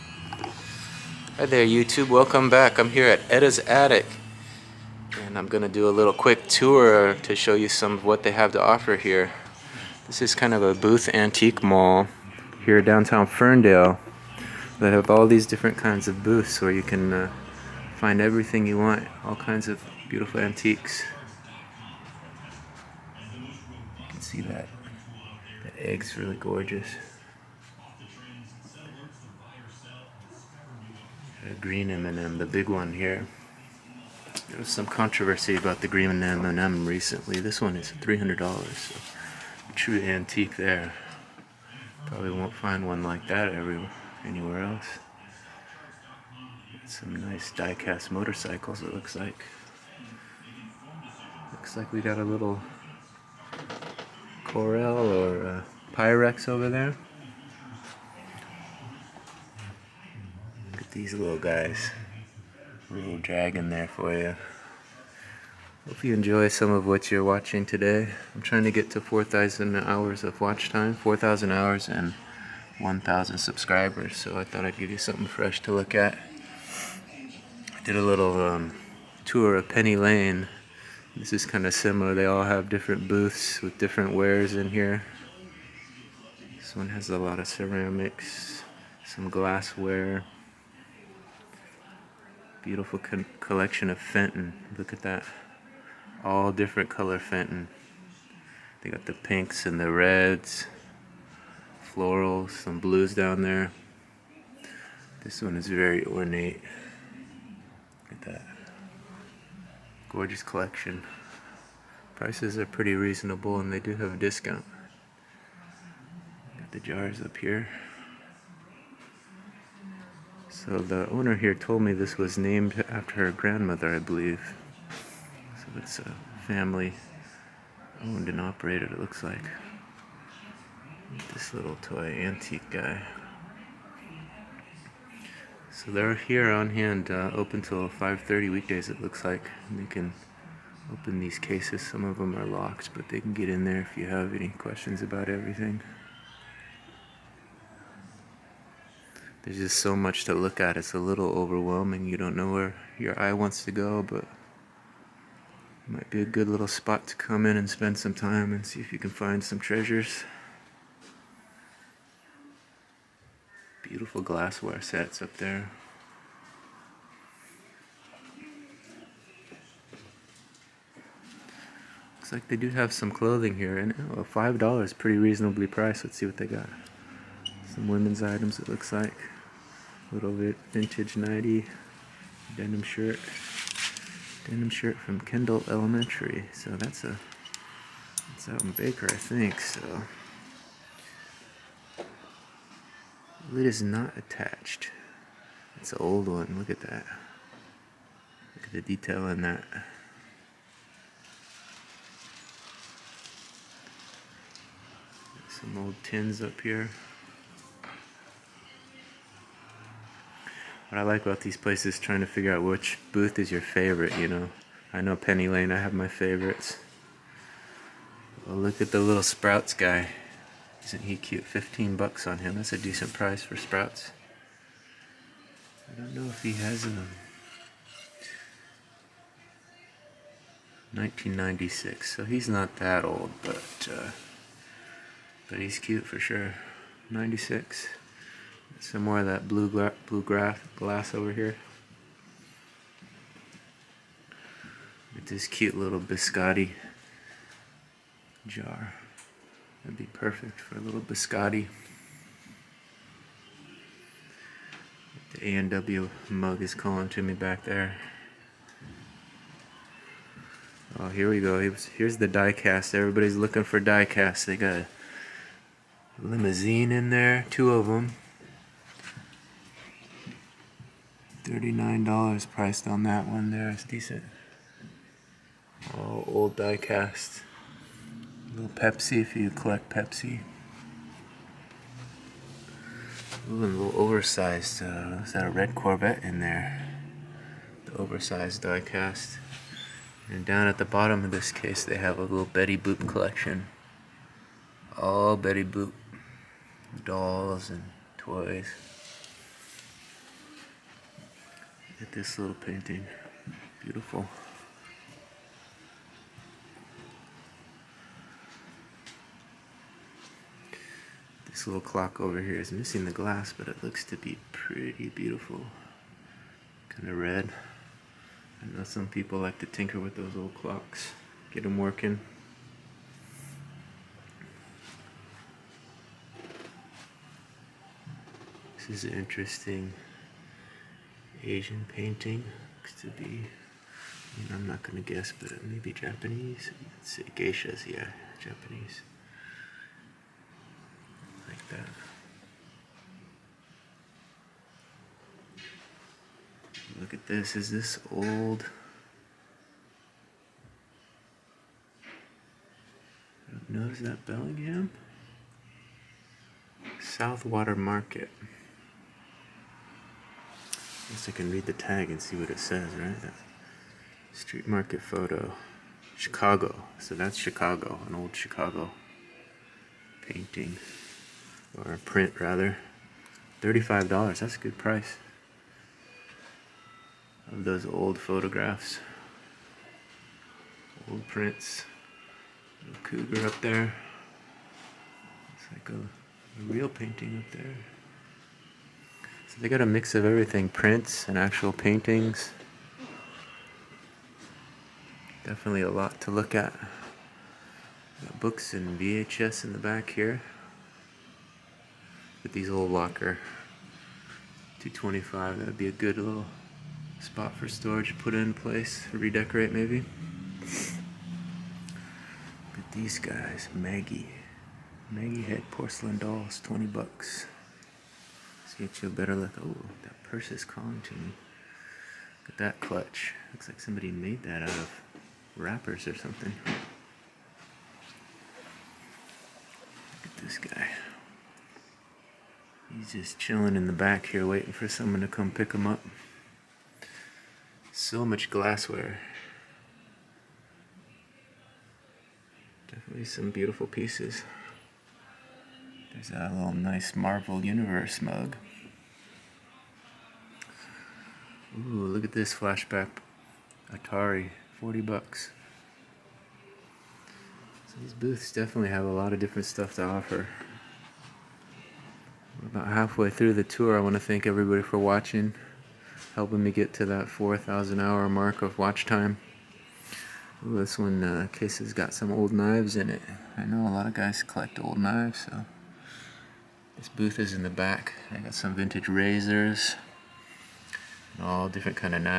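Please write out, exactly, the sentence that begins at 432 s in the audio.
He's just chilling in the back here waiting for someone to come pick him up.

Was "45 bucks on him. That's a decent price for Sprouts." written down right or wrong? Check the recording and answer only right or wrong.
wrong.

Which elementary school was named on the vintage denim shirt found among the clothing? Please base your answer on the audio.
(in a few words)
Kendall Elementary.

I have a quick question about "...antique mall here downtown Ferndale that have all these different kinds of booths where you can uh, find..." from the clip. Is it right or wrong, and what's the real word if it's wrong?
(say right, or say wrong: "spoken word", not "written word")
right.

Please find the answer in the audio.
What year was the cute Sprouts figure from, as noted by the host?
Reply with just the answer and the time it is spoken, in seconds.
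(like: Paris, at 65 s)
1996, at 231 s.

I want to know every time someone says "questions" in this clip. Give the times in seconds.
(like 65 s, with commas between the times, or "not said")
144 s.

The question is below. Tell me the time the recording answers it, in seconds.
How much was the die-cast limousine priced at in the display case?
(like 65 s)
271 s.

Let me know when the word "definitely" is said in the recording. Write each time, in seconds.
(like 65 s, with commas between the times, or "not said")
395 s, 442 s, 458 s.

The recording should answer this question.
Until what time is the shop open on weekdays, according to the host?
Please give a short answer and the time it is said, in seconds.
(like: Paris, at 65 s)
5:30, at 137 s.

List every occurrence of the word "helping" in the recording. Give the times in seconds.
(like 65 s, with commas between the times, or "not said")
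466 s.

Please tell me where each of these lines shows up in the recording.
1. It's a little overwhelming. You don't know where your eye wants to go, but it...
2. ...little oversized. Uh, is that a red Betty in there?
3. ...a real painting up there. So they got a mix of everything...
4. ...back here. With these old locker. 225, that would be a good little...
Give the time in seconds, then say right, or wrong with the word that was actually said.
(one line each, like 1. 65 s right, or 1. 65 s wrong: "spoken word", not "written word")
1. 150 s right
2. 283 s wrong: "Corvette", not "Betty"
3. 385 s right
4. 399 s right.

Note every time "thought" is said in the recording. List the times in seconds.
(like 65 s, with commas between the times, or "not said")
74 s.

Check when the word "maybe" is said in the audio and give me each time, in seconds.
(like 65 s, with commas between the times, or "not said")
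335 s, 409 s.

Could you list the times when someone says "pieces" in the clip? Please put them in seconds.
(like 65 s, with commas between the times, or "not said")
443 s.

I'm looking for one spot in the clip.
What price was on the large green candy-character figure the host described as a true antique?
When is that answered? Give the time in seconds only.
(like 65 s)
37 s.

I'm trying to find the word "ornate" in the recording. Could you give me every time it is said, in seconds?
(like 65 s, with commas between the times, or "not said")
106 s.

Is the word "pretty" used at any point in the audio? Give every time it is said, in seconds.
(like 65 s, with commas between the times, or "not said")
112 s, 174 s, 314 s.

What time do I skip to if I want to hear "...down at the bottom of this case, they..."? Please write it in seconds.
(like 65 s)
290 s.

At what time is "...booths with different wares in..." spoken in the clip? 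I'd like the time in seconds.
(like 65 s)
83 s.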